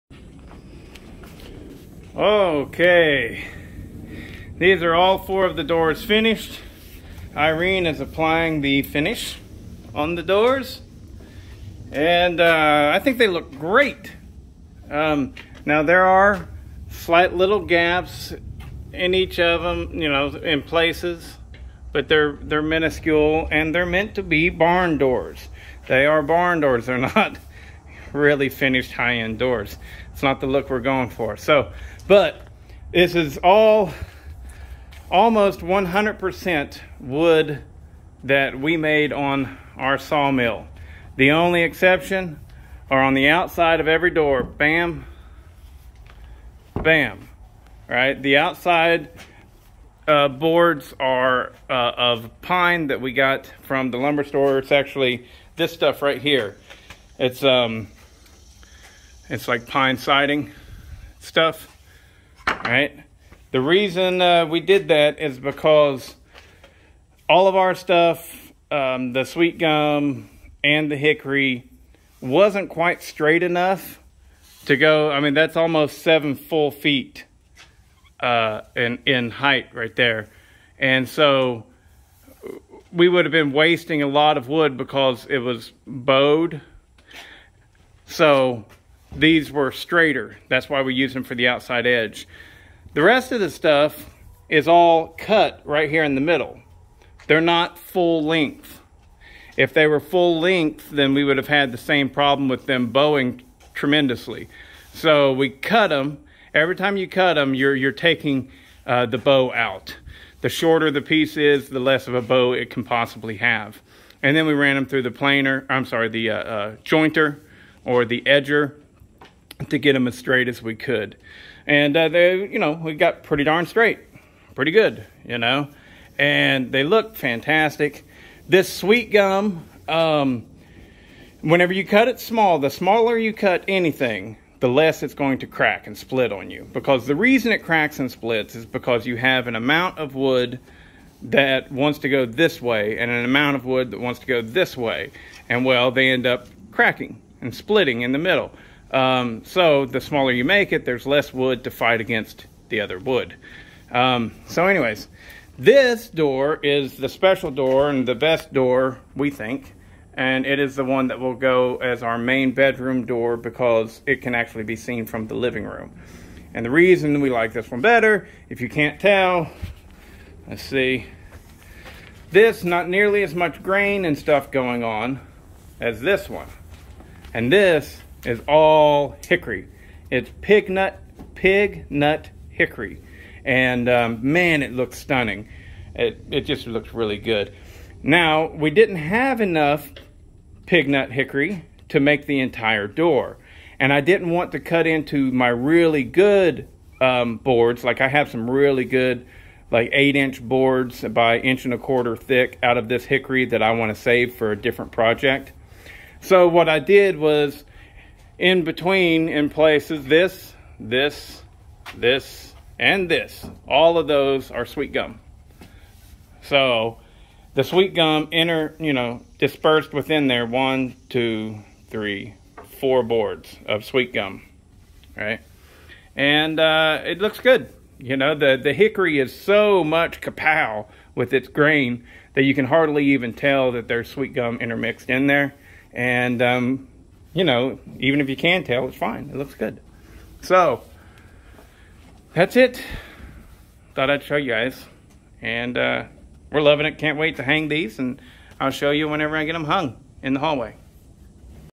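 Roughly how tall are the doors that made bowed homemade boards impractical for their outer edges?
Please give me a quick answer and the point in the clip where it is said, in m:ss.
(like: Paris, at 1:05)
7 feet, at 1:15.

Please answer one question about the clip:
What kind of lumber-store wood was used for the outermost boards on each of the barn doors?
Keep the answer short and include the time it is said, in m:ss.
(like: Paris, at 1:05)
Pine siding, at 0:59.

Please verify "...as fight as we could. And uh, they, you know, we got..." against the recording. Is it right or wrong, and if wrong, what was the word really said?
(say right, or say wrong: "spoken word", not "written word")
wrong: "straight", not "fight".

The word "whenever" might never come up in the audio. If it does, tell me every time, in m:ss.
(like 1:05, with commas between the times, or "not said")
2:11, 4:09.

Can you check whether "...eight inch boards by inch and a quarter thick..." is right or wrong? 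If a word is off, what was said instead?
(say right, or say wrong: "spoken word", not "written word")
right.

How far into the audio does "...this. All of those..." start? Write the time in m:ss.
3:33.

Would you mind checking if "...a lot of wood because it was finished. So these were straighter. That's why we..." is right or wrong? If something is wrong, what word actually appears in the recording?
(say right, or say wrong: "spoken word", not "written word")
wrong: "bowed", not "finished".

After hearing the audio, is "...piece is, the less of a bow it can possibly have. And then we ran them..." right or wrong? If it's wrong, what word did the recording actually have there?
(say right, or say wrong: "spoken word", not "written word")
right.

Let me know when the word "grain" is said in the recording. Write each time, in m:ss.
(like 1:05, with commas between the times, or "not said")
2:53, 3:51.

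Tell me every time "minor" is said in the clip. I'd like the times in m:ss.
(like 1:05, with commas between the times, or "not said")
not said.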